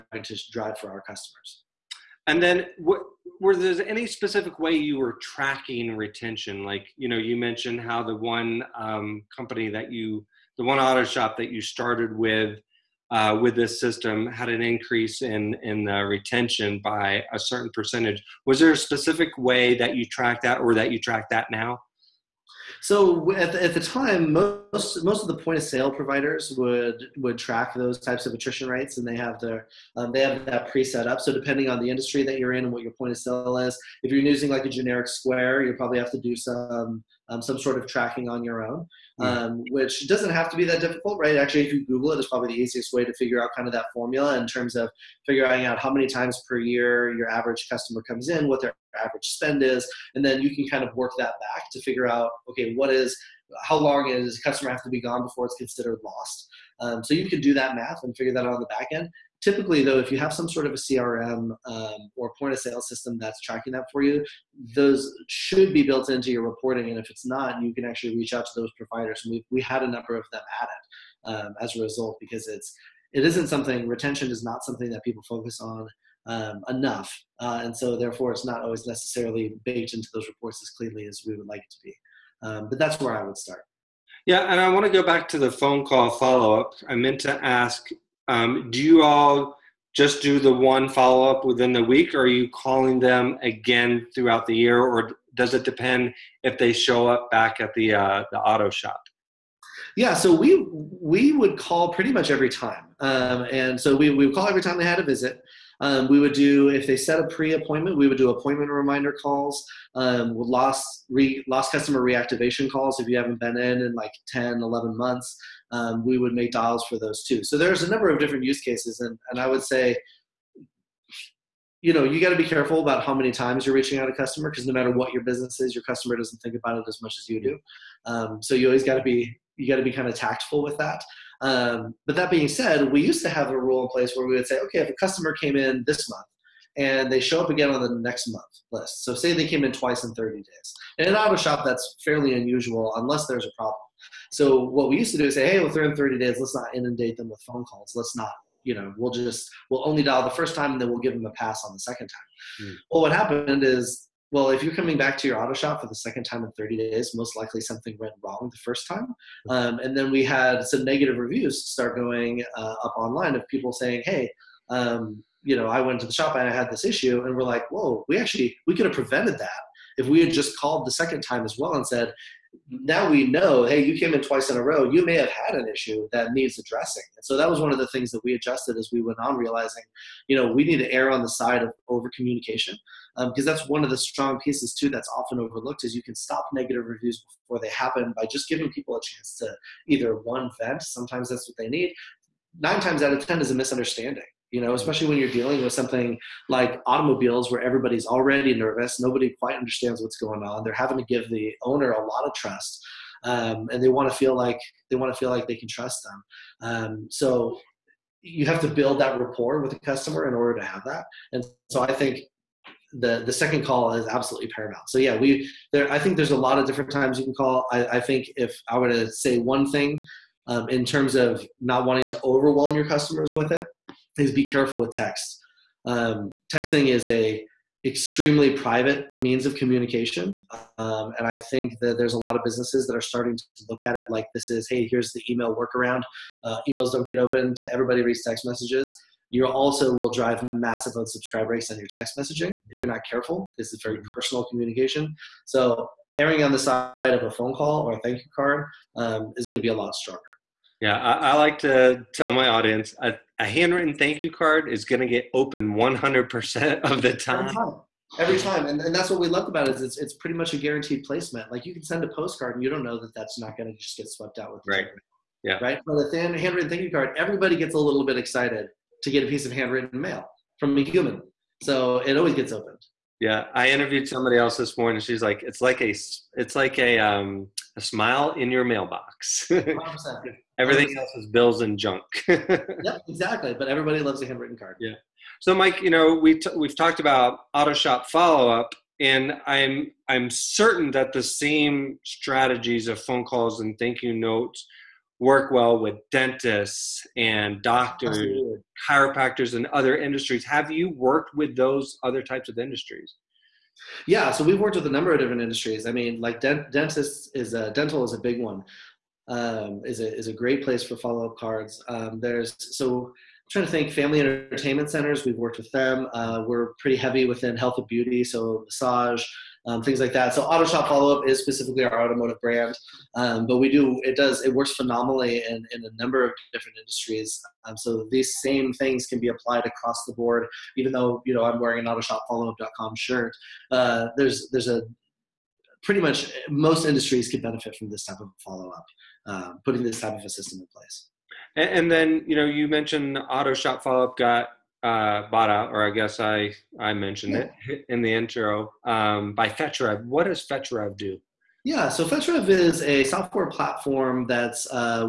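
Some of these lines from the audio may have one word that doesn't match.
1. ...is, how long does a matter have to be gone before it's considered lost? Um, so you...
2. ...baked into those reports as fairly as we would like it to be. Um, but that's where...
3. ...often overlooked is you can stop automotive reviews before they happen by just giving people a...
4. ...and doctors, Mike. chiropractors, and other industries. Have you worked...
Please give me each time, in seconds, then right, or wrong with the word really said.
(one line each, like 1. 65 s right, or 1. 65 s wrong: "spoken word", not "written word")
1. 52 s wrong: "customer", not "matter"
2. 79 s wrong: "cleanly", not "fairly"
3. 185 s wrong: "negative", not "automotive"
4. 297 s wrong: "Absolutely", not "Mike".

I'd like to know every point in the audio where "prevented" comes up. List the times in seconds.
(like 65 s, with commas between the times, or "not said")
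168 s.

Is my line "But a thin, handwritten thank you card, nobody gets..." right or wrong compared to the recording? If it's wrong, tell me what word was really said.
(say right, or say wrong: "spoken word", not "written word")
wrong: "everybody", not "nobody".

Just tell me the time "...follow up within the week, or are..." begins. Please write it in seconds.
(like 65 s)
90 s.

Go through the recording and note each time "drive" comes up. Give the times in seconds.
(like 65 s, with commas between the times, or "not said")
0 s, 240 s.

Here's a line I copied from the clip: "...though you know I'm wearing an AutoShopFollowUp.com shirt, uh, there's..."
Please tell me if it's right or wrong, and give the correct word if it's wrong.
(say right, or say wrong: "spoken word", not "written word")
right.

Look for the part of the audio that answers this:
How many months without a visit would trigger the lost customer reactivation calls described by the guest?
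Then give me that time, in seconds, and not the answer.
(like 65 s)
114 s.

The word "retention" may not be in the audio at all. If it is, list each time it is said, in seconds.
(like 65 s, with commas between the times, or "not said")
5 s, 16 s, 73 s.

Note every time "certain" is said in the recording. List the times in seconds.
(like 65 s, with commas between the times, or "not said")
17 s, 290 s.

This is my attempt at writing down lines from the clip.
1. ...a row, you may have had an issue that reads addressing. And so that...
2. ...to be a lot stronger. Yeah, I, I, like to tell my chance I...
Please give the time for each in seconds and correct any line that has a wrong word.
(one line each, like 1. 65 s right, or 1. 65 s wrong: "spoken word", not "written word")
1. 174 s wrong: "needs", not "reads"
2. 249 s wrong: "audience", not "chance".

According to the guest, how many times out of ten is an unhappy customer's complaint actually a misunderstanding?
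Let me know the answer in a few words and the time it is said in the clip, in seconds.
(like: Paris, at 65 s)
9, at 192 s.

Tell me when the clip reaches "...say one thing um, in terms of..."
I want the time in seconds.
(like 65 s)
219 s.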